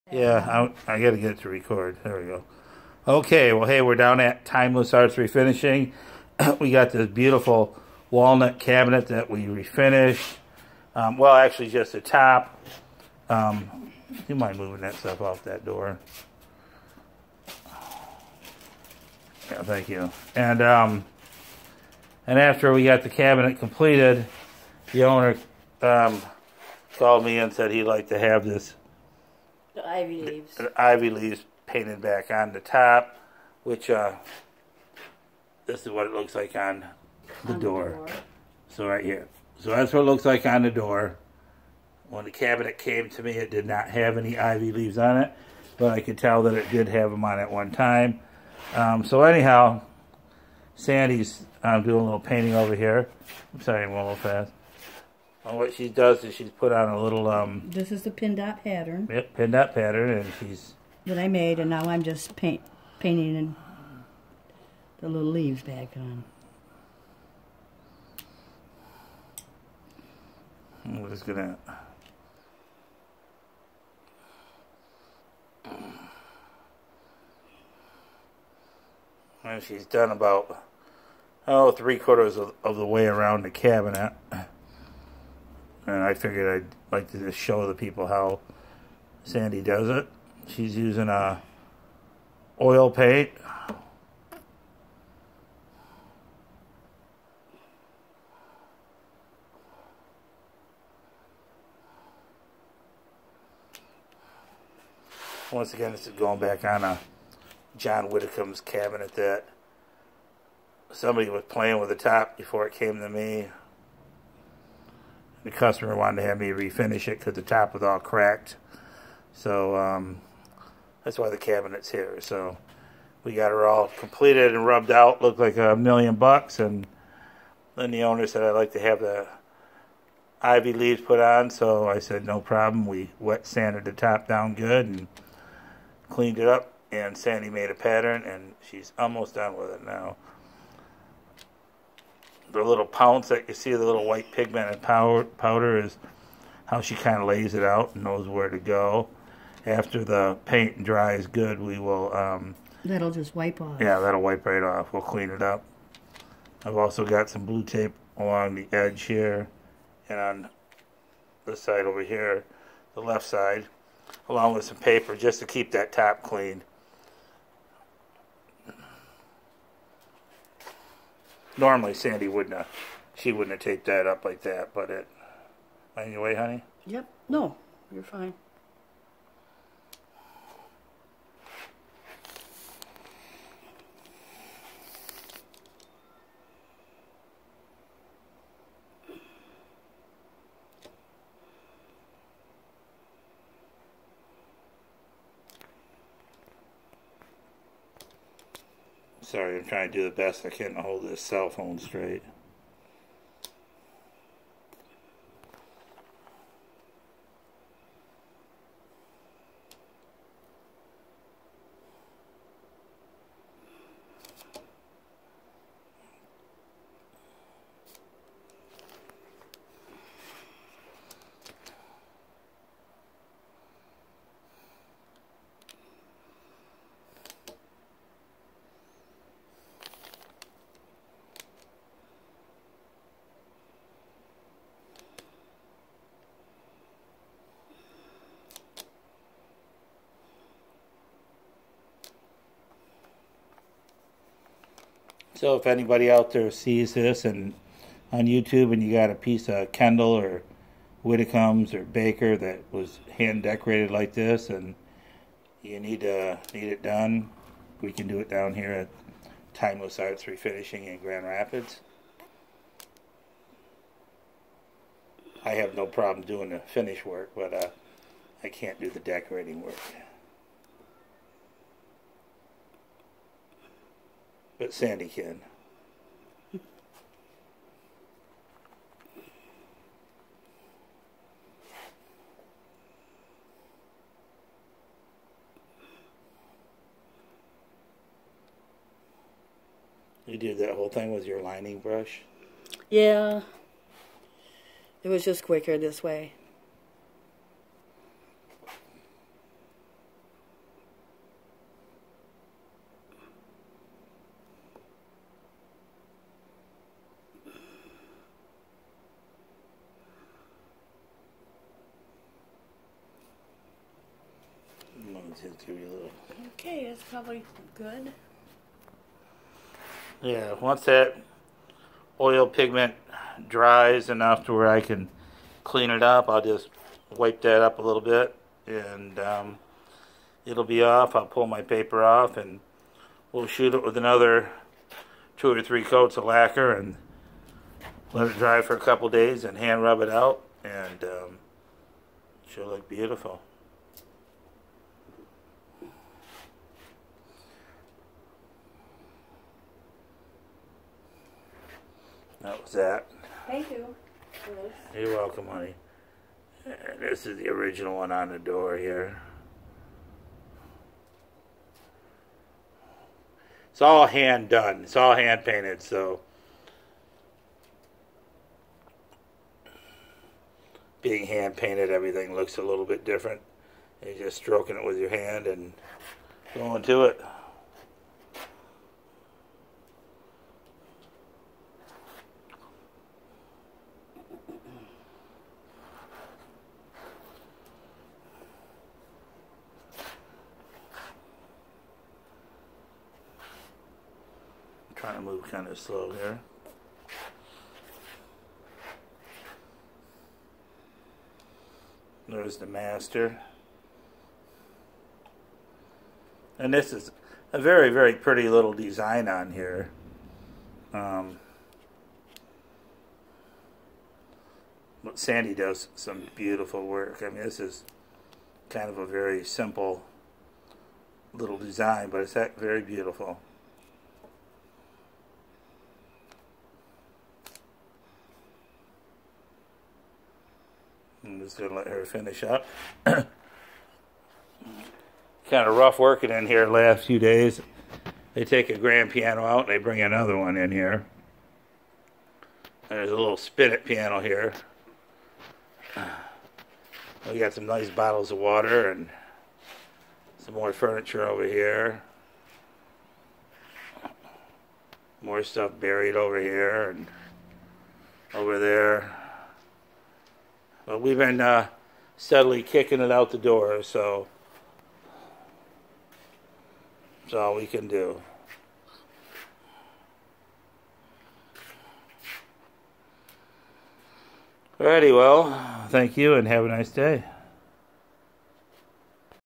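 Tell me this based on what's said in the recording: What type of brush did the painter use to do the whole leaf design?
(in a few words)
Lining brush.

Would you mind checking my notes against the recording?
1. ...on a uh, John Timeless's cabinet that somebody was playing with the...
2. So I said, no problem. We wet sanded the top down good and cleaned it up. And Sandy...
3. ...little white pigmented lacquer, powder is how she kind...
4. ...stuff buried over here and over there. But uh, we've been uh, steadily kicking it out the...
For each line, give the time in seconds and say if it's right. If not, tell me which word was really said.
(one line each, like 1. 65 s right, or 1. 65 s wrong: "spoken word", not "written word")
1. 106 s wrong: "Widdicomb", not "Timeless"
2. 131 s right
3. 143 s wrong: "powder", not "lacquer"
4. 455 s right.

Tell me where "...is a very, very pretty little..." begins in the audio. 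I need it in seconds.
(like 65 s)
406 s.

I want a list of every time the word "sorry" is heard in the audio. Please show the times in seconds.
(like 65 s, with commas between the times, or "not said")
53 s, 199 s.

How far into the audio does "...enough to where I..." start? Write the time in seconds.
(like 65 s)
324 s.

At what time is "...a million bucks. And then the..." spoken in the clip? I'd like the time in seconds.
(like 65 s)
125 s.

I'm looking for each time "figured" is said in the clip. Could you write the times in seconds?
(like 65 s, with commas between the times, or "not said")
86 s.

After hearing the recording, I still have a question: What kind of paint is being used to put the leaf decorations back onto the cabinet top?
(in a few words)
Oil paint.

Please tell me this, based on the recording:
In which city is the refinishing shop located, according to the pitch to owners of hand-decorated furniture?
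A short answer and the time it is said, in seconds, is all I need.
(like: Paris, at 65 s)
Grand Rapids, at 260 s.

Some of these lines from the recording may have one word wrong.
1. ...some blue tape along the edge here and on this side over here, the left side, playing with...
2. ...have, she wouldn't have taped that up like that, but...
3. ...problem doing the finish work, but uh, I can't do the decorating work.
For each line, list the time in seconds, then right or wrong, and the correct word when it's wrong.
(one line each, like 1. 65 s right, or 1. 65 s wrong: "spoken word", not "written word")
1. 157 s wrong: "along", not "playing"
2. 172 s right
3. 265 s right.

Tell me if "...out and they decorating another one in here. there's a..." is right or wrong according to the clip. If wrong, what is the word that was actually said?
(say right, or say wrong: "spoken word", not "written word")
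wrong: "bring", not "decorating".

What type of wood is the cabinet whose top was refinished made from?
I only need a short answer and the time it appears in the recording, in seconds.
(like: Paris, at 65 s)
Walnut, at 8 s.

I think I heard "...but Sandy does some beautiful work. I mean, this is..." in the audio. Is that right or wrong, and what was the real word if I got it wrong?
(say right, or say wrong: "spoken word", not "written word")
right.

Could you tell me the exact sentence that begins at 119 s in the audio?
So um, that's why the cabinet's here.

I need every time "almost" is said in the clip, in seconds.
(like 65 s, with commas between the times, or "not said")
138 s.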